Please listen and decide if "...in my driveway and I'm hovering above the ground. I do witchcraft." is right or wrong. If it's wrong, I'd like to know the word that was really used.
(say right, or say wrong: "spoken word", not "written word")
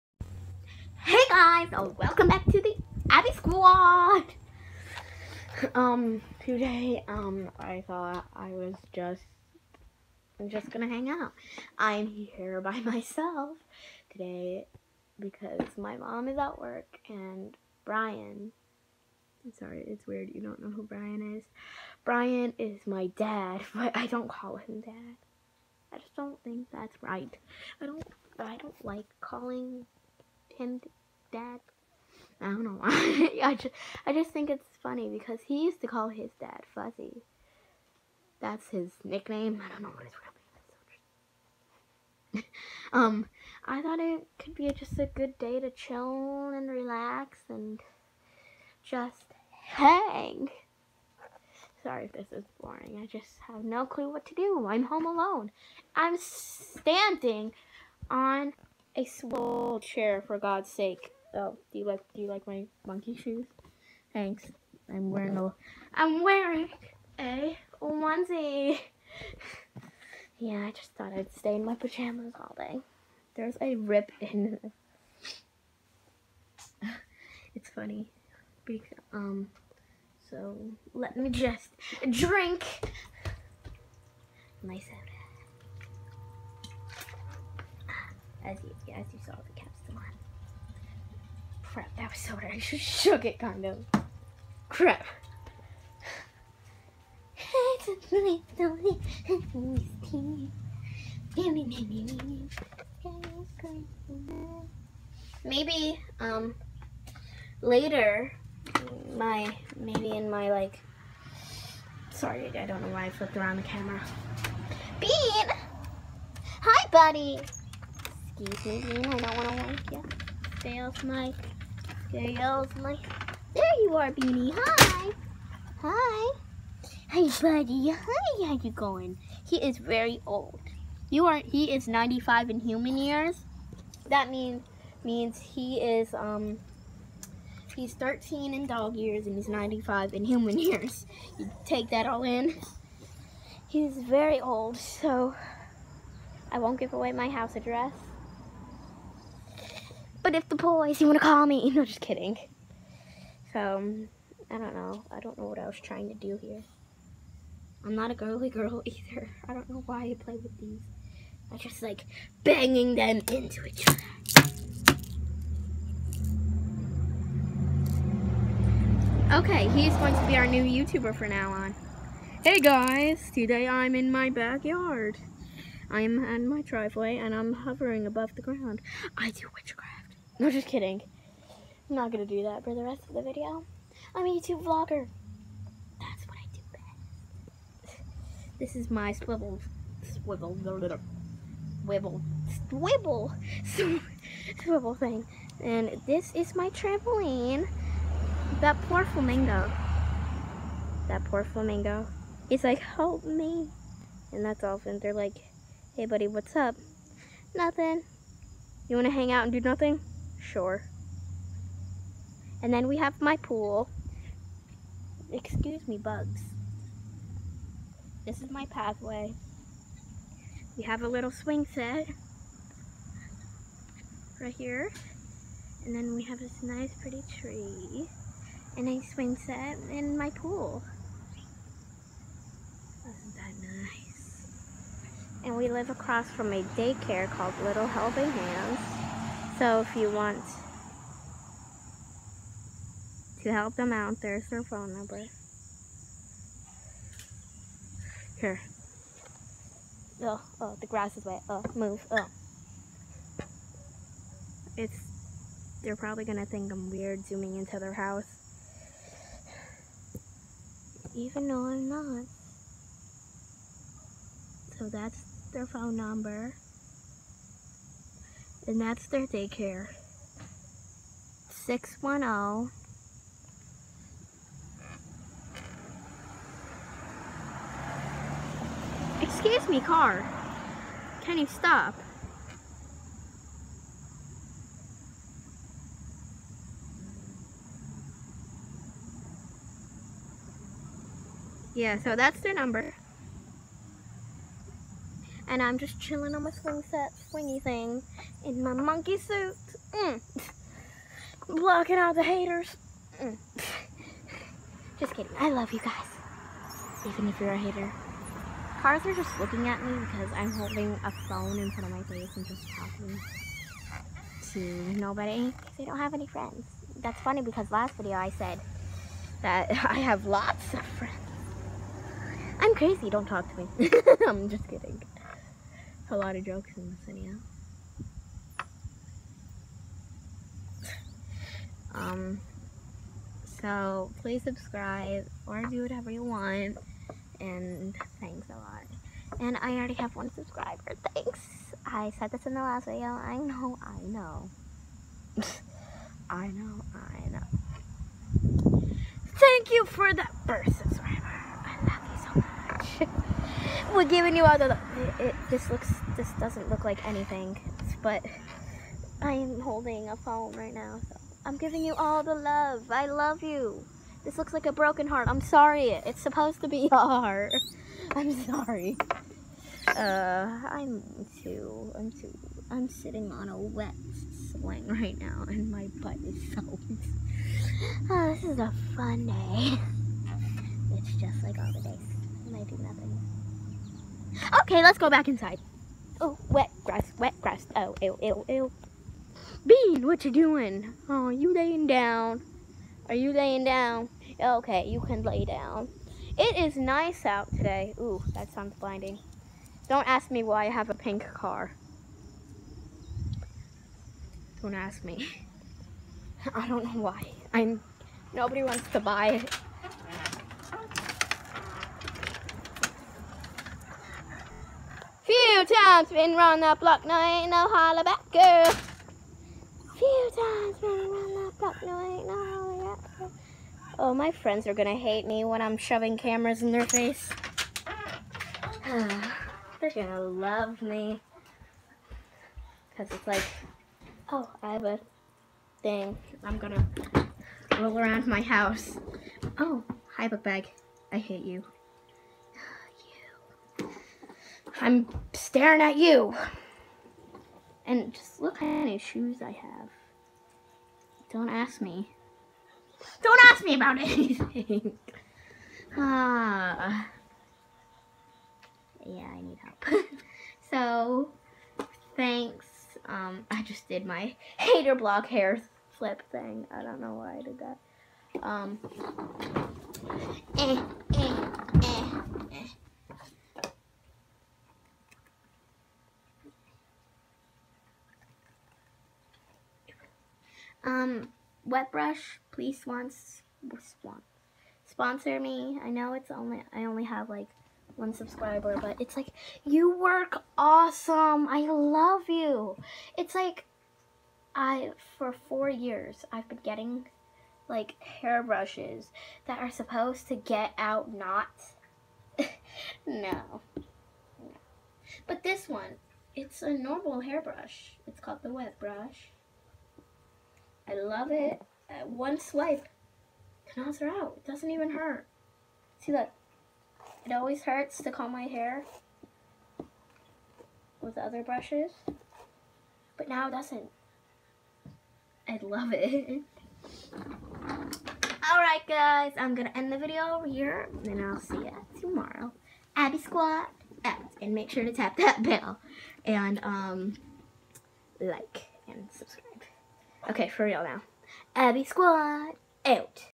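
right.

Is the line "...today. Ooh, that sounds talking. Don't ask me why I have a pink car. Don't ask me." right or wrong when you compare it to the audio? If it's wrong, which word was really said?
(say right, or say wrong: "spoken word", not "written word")
wrong: "blinding", not "talking".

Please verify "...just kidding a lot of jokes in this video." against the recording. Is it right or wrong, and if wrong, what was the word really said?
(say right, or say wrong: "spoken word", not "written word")
right.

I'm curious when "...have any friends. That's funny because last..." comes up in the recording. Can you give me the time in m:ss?
5:15.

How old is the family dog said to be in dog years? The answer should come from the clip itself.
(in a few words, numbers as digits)
13.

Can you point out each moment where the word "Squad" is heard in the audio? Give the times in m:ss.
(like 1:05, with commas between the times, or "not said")
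0:03, 8:53, 9:01.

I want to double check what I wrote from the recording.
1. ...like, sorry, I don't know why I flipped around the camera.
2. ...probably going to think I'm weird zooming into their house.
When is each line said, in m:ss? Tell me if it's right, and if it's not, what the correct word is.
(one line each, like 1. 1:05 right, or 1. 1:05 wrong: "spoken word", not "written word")
1. 1:50 right
2. 4:15 right.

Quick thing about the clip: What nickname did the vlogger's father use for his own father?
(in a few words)
Fuzzy.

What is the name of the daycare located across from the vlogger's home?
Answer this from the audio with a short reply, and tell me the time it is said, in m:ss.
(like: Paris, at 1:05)
Little Helping Hands, at 3:57.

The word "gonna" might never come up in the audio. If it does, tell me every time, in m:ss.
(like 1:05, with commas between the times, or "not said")
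0:10, 7:04, 7:09, 7:16, 8:49.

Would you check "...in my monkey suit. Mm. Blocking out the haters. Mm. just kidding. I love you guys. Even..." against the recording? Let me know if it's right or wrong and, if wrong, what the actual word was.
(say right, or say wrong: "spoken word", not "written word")
right.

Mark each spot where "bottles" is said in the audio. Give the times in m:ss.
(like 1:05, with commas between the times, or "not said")
not said.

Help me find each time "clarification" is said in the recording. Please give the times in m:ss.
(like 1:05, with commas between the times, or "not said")
not said.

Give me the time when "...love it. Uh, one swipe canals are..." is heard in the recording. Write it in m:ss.
8:30.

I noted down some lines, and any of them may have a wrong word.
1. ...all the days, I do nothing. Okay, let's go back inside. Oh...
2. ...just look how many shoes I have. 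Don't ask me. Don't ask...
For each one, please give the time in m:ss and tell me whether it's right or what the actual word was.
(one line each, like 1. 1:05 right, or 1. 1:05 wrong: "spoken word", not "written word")
1. 6:21 right
2. 7:28 right.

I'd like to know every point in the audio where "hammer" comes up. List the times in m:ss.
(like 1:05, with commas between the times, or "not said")
not said.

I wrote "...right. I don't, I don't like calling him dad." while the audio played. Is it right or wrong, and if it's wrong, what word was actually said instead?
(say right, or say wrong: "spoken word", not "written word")
right.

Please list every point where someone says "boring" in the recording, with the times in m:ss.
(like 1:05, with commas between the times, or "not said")
0:52.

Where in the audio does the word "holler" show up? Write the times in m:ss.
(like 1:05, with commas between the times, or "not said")
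6:57, 7:02.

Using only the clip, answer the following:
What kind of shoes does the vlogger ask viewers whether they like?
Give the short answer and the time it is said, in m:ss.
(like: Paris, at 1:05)
Monkey shoes, at 1:02.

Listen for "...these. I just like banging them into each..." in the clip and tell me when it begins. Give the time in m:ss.
2:40.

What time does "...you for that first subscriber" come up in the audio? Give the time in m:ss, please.
5:49.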